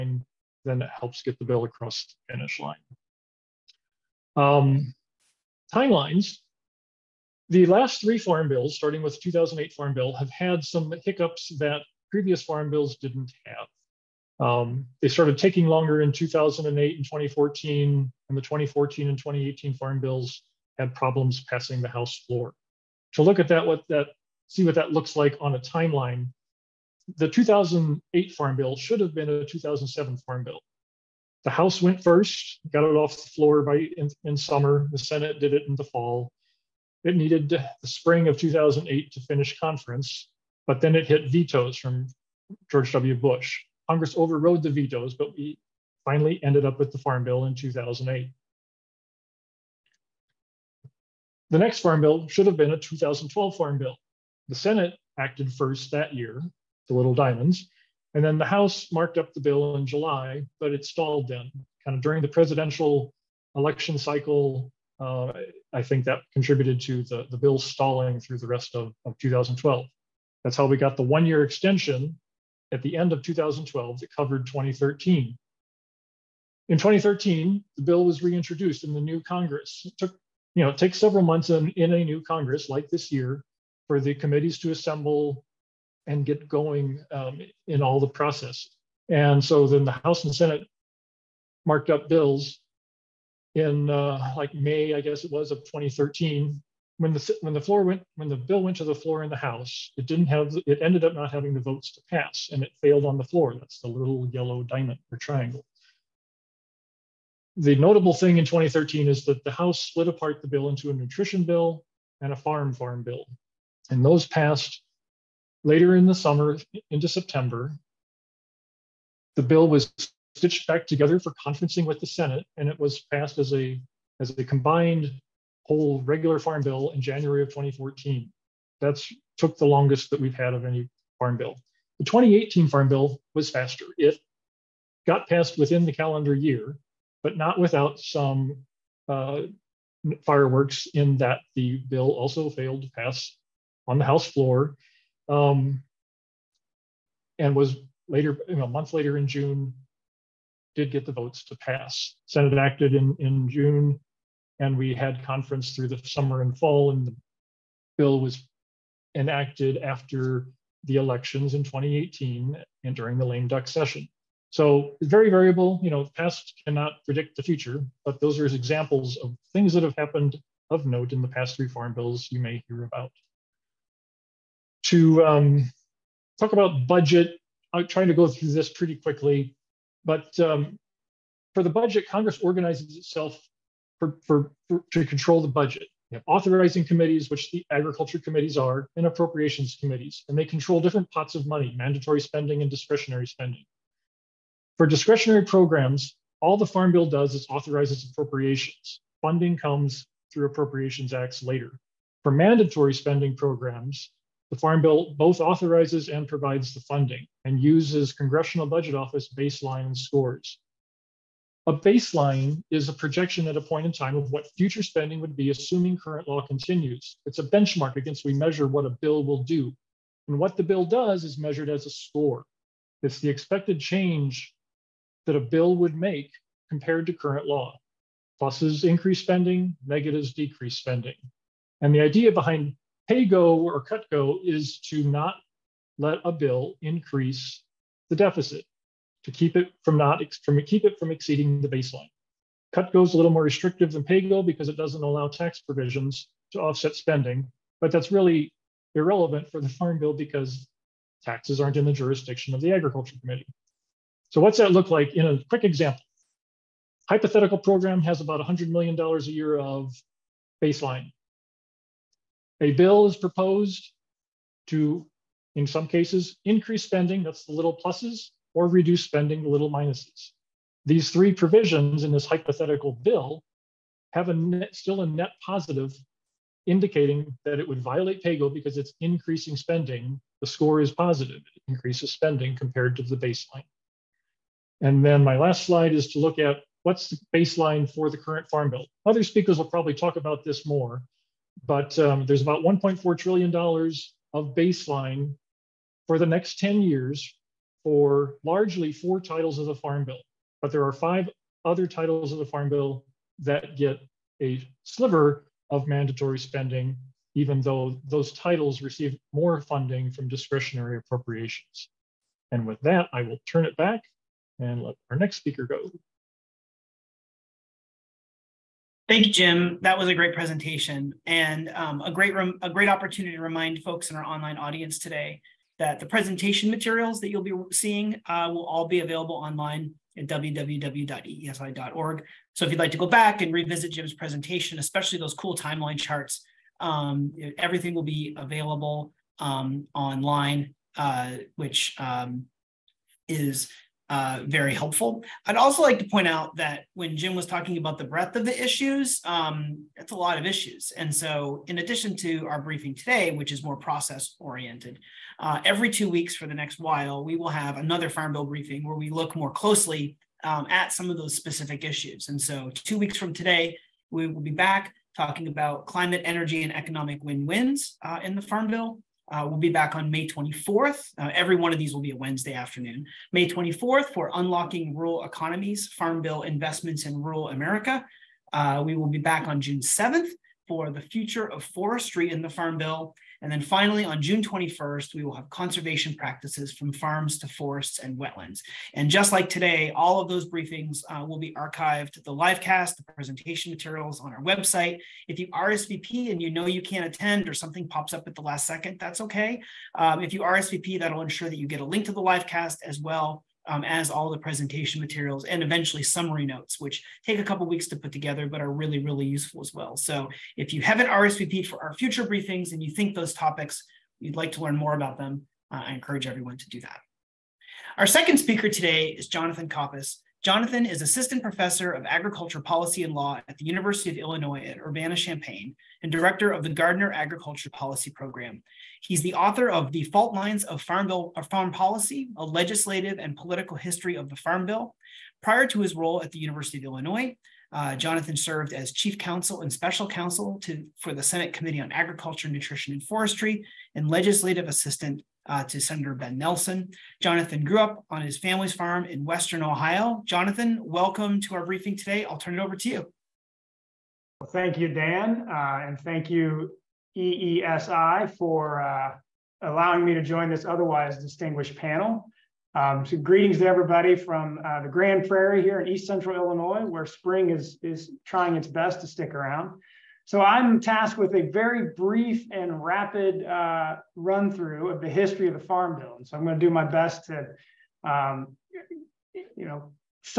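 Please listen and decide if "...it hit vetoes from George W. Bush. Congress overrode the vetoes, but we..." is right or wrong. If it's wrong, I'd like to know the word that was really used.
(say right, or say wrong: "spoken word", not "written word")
right.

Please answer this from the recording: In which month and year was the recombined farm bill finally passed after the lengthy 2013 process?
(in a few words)
January 2014.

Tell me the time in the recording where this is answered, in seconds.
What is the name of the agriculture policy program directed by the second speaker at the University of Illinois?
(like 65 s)
426 s.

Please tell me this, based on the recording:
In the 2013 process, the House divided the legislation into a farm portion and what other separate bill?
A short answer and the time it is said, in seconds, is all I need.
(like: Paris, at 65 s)
Nutrition bill, at 110 s.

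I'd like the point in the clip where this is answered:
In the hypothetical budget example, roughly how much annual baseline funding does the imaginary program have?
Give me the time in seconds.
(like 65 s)
258 s.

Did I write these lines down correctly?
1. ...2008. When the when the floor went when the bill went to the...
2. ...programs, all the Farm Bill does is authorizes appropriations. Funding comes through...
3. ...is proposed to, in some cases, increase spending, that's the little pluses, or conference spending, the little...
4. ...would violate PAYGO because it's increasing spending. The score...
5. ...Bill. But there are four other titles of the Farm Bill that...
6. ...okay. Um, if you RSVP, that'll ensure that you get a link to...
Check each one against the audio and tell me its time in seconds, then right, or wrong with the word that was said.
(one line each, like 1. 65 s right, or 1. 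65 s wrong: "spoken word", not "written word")
1. 95 s wrong: "2013", not "2008"
2. 195 s right
3. 263 s wrong: "reduce", not "conference"
4. 277 s right
5. 300 s wrong: "five", not "four"
6. 399 s right.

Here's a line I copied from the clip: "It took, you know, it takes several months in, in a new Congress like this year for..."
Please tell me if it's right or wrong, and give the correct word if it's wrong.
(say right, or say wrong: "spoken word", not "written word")
right.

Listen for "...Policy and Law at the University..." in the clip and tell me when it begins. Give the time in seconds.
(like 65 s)
422 s.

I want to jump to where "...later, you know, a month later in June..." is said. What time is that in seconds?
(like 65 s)
148 s.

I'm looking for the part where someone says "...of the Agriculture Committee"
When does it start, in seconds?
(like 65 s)
252 s.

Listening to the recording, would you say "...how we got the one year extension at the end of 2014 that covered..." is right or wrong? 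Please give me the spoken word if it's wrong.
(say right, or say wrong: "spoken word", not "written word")
wrong: "2012", not "2014".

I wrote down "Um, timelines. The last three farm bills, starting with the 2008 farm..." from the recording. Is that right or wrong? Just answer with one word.
right.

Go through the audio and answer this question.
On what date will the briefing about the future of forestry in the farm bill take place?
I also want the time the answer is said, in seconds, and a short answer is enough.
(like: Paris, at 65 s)
June 7th, at 379 s.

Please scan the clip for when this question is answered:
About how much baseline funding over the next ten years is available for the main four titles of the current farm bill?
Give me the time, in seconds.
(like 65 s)
292 s.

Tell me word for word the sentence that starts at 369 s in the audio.
Uh, we'll be back on May 24th.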